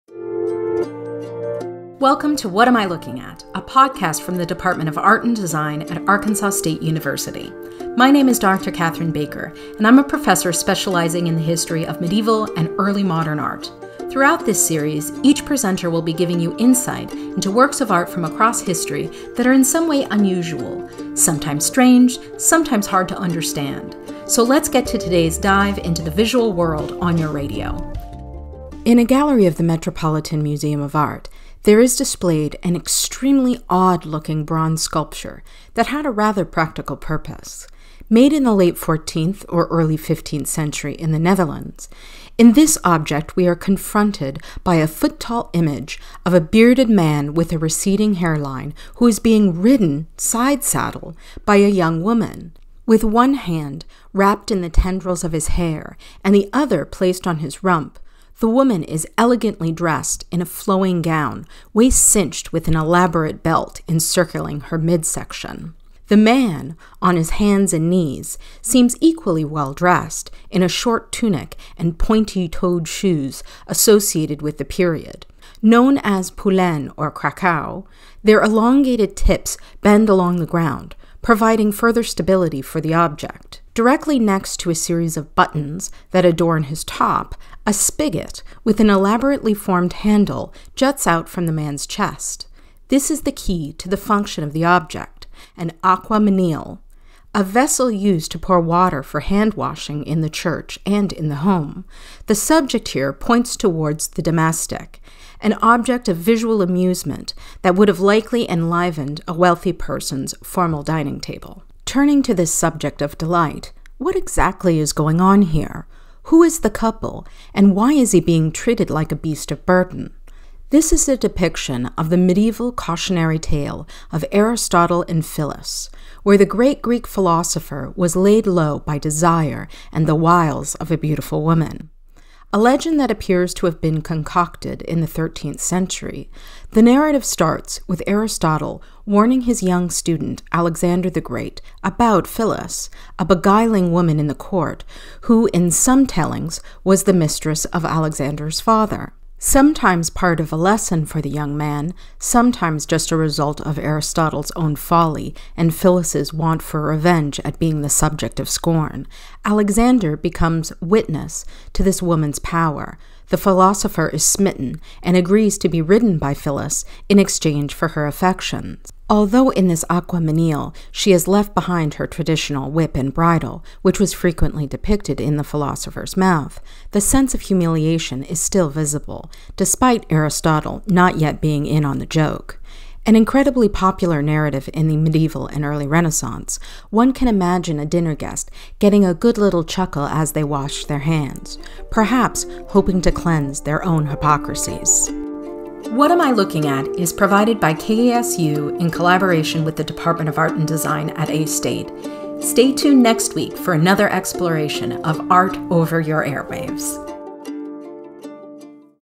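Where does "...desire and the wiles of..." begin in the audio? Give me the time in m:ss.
2:08.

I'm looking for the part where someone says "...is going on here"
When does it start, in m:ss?
1:54.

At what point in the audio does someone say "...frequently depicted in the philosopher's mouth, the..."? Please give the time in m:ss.
2:54.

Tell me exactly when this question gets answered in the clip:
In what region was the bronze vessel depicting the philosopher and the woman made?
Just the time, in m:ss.
0:41.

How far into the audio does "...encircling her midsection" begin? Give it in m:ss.
1:03.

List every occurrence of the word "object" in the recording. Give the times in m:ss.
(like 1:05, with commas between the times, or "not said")
0:42, 1:22, 1:34, 1:45.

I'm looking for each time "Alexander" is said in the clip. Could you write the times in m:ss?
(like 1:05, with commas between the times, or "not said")
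2:20, 2:27, 2:39.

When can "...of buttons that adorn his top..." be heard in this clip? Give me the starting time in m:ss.
1:25.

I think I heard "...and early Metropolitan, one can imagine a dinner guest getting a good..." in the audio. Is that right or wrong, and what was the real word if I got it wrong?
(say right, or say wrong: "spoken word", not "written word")
wrong: "Renaissance", not "Metropolitan".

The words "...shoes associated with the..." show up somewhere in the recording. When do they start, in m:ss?
1:12.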